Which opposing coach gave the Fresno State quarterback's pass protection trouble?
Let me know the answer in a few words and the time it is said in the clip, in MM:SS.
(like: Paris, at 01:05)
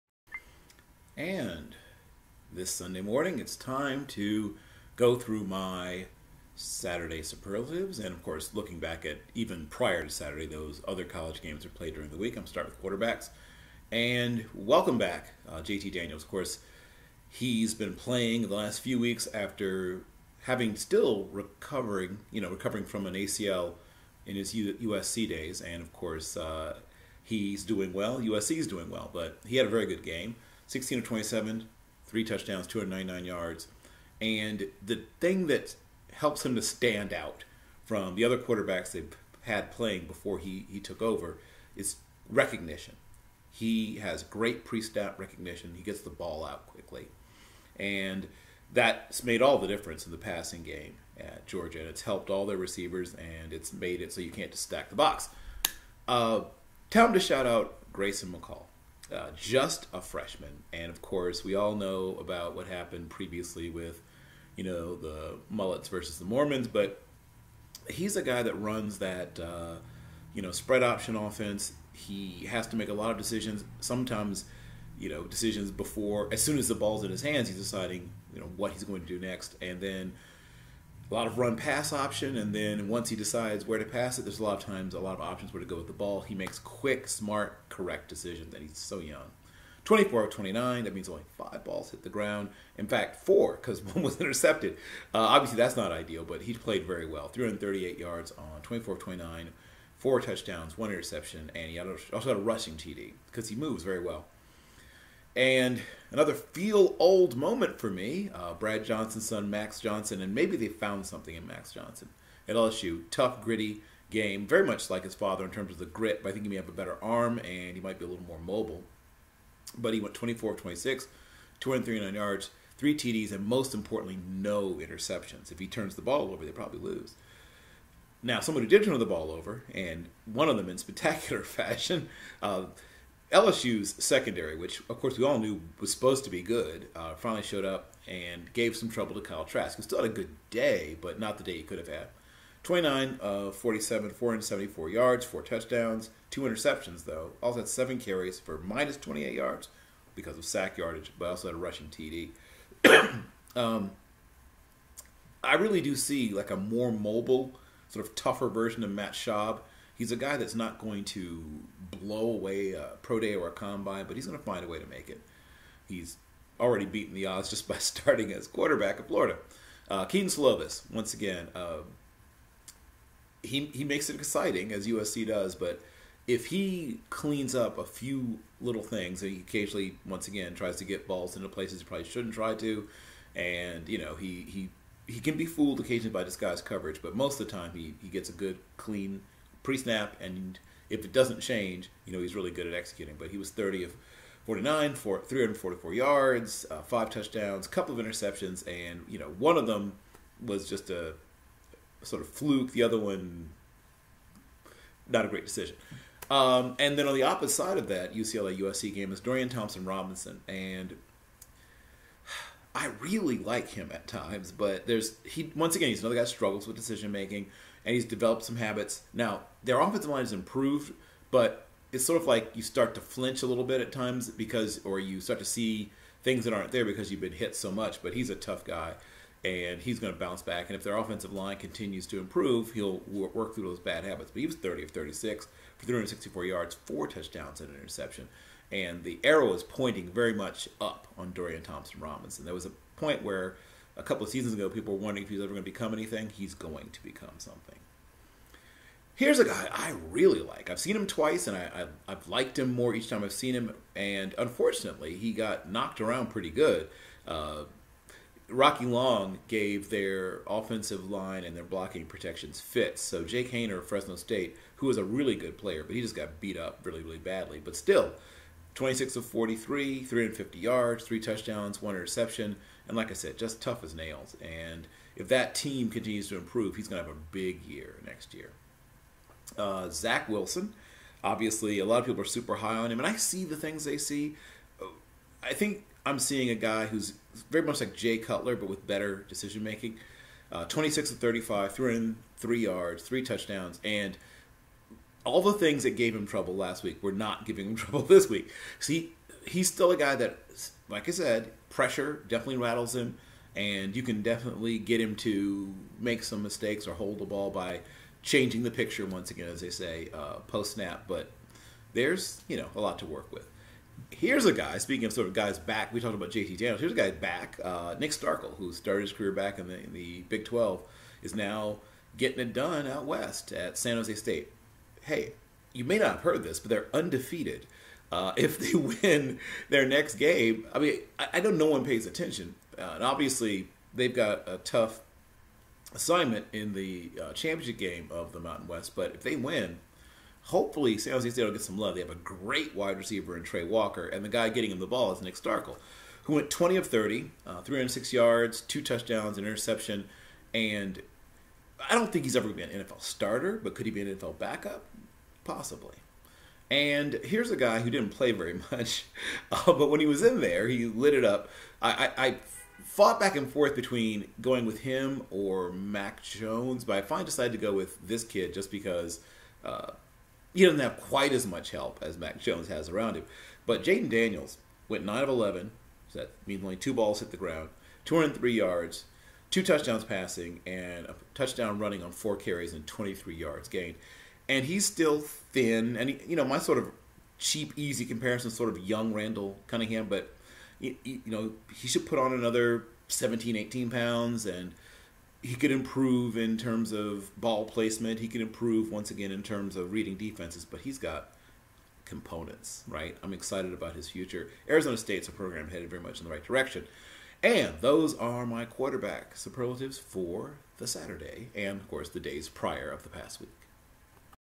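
Rocky Long, at 04:18.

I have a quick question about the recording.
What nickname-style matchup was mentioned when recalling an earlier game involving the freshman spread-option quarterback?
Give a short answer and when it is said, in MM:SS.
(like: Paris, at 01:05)
the Mullets versus the Mormons, at 01:04.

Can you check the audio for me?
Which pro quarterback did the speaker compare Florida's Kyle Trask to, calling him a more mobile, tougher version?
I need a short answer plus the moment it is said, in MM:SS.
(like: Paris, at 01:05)
Matt Schaub, at 02:38.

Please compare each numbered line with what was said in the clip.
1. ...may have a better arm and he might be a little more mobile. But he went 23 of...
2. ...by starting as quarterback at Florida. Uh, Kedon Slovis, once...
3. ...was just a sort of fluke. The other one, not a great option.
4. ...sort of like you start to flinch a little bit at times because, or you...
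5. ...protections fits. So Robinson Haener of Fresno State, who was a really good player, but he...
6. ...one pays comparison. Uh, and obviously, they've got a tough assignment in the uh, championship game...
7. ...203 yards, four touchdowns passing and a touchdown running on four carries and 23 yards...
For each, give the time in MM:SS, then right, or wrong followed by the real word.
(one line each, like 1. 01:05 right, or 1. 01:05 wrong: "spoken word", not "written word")
1. 01:56 wrong: "24", not "23"
2. 02:47 right
3. 03:20 wrong: "decision", not "option"
4. 03:42 right
5. 04:22 wrong: "Jake", not "Robinson"
6. 05:31 wrong: "attention", not "comparison"
7. 06:18 wrong: "two", not "four".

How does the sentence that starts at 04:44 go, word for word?
Uh, I think I'm seeing a guy who's very much like Jay Cutler, but with better decision making.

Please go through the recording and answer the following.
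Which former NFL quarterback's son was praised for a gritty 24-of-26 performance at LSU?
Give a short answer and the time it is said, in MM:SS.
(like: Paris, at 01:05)
Brad Johnson, at 01:48.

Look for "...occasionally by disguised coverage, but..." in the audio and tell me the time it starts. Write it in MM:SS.
03:05.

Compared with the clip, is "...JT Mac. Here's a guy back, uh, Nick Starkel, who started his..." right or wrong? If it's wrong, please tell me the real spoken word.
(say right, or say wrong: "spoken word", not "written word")
wrong: "Daniels", not "Mac".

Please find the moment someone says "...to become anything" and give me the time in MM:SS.
04:05.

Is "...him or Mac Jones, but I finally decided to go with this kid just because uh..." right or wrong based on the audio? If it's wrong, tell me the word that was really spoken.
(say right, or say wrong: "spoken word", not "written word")
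right.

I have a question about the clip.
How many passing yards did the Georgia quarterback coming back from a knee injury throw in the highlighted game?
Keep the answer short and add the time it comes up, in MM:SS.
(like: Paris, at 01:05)
299, at 00:32.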